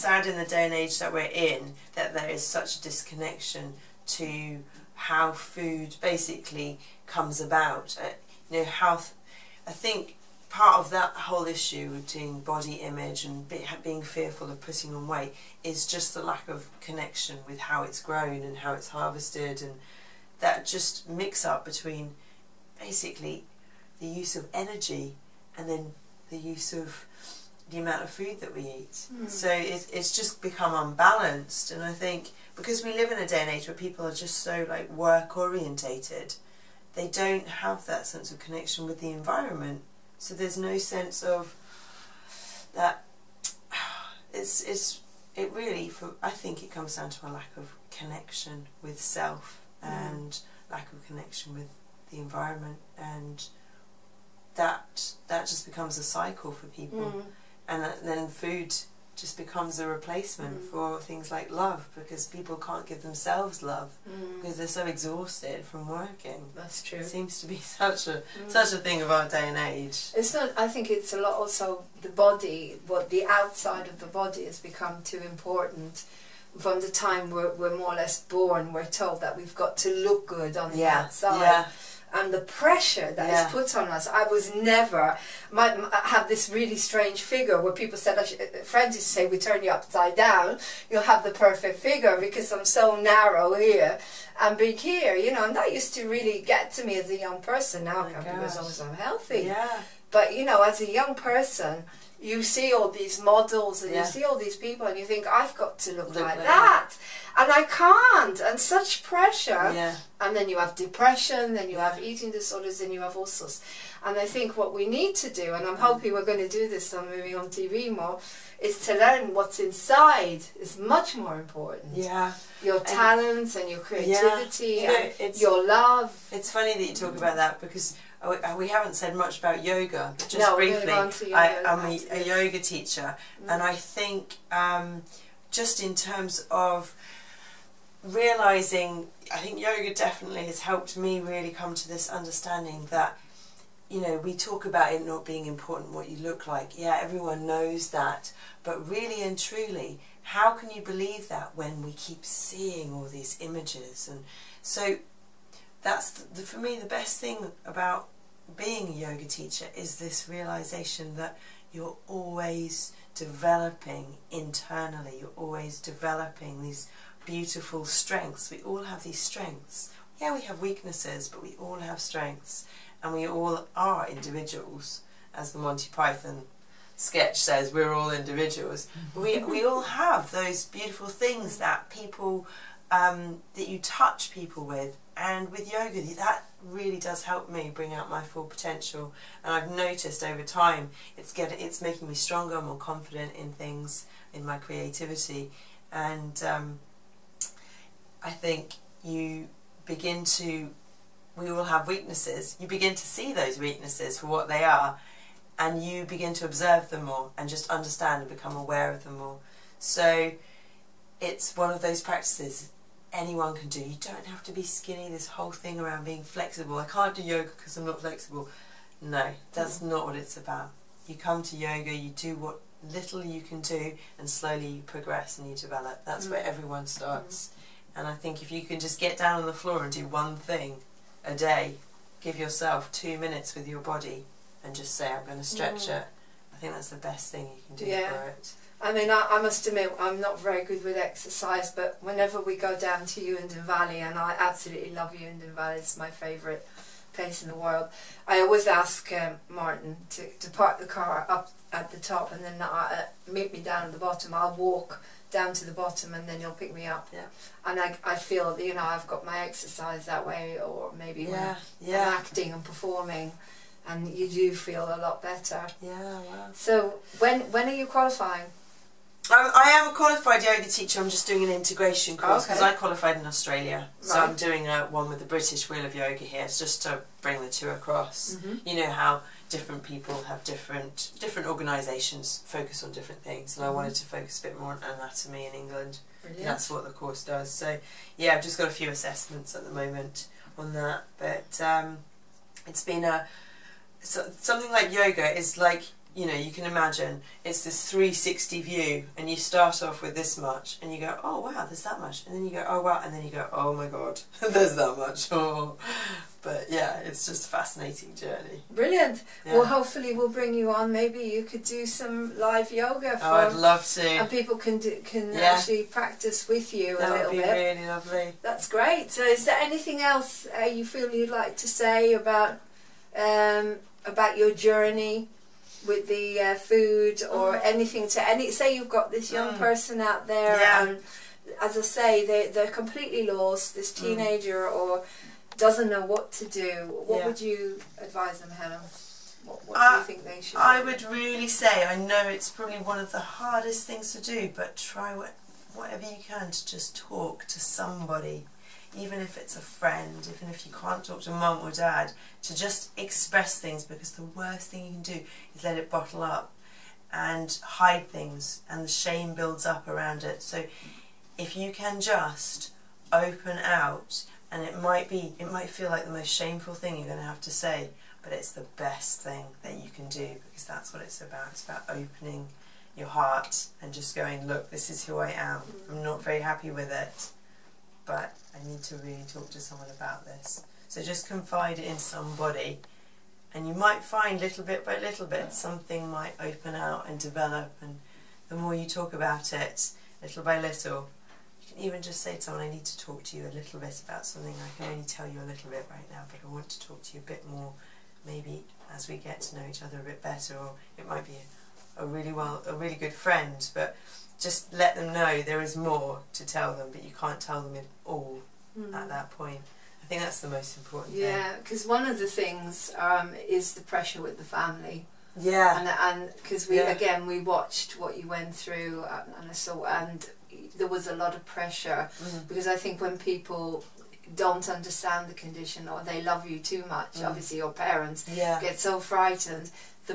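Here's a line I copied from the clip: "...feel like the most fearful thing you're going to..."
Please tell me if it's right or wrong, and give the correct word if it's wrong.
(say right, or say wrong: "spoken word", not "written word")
wrong: "shameful", not "fearful".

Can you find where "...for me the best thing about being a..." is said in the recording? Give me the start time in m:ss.
2:36.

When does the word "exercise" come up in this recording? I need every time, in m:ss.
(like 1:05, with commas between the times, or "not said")
4:00, 4:19.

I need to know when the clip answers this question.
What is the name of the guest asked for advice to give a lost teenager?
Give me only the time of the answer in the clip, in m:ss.
5:38.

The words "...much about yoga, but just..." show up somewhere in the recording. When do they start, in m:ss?
2:09.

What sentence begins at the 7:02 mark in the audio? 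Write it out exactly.
because I think when people don't understand the condition or they love you too much, mm.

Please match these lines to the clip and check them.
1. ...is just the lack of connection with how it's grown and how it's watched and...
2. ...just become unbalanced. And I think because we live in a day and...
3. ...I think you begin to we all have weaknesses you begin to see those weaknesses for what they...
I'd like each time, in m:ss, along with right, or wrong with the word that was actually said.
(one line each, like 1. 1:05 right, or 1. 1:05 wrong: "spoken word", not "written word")
1. 0:15 wrong: "harvested", not "watched"
2. 0:30 right
3. 3:18 right.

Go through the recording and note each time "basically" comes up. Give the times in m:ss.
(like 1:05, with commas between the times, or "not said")
0:06, 0:22.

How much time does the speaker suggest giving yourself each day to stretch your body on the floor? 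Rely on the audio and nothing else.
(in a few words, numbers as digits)
2 minutes.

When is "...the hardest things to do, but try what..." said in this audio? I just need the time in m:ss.
5:43.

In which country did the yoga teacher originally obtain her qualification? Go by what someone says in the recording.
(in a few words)
Australia.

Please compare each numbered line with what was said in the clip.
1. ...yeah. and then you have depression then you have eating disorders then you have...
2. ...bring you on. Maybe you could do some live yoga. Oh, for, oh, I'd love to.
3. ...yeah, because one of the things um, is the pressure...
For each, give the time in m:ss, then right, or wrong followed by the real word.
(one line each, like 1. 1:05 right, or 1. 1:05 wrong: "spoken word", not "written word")
1. 1:49 right
2. 5:10 right
3. 6:51 right.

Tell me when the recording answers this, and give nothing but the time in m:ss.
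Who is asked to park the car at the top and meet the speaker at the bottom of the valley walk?
4:09.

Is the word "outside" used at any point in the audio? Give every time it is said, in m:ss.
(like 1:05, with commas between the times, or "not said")
1:13, 1:21.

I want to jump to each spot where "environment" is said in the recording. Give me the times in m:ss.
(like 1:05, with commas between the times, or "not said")
0:39, 0:52.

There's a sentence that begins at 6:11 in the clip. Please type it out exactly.
It's about opening your heart and just going, look, this is who I am.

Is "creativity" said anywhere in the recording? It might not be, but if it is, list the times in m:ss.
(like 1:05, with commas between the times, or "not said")
2:03, 3:14.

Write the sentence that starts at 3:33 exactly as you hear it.
You don't have to be skinny, this whole thing around being flexible.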